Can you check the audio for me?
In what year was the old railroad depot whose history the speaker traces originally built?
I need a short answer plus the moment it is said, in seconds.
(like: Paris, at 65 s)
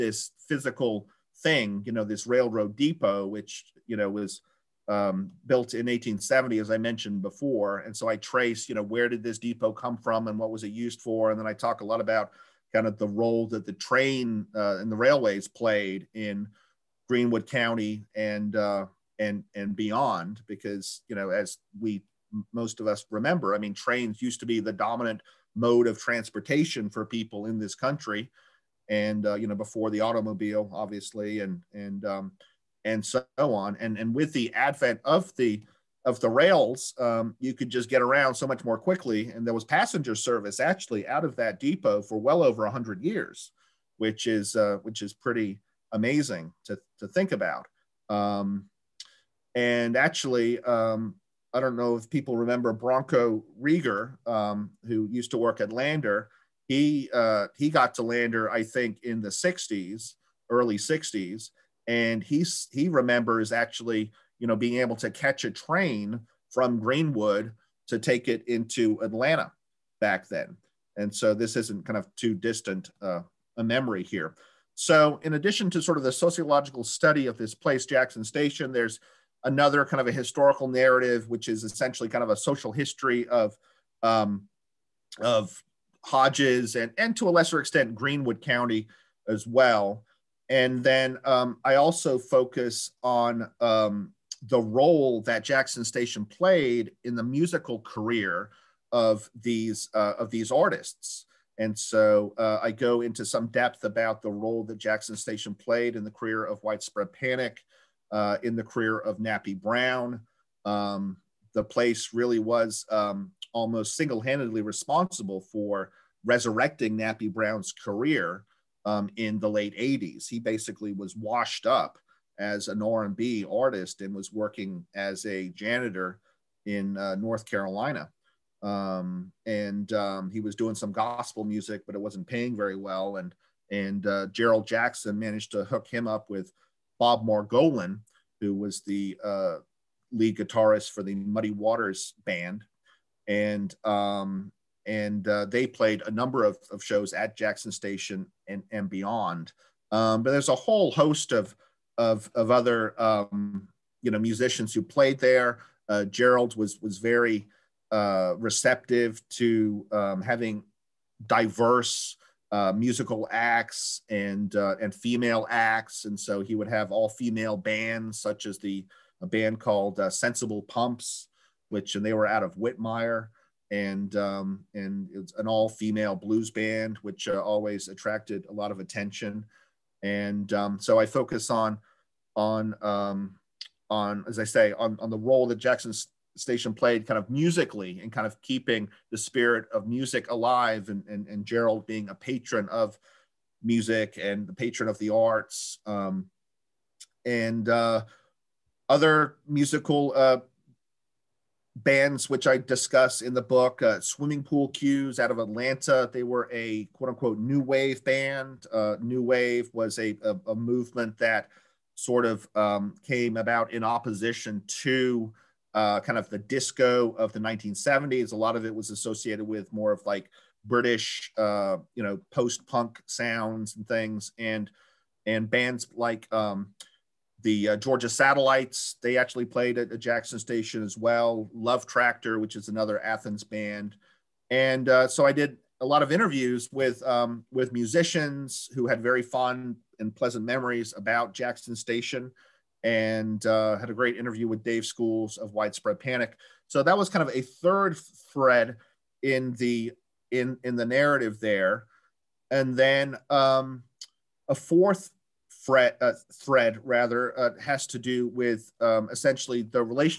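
1870, at 5 s.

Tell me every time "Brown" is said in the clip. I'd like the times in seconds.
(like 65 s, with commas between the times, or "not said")
109 s, 117 s.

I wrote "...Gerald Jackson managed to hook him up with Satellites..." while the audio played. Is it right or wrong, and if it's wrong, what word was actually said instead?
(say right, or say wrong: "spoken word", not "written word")
wrong: "Bob", not "Satellites".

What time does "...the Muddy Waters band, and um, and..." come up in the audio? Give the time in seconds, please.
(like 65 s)
141 s.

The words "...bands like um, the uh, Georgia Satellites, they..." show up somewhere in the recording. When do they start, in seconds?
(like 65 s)
225 s.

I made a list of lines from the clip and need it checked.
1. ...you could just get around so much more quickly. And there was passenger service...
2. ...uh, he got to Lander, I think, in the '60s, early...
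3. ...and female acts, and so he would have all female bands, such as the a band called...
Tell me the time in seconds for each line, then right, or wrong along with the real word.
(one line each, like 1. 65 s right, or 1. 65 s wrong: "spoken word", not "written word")
1. 37 s right
2. 57 s right
3. 164 s right.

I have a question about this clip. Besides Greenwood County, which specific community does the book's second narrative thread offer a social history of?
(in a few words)
Hodges.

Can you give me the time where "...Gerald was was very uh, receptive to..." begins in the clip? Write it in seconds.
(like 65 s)
156 s.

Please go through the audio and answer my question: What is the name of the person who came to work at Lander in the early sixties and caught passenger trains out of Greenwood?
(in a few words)
Bronco Rieger.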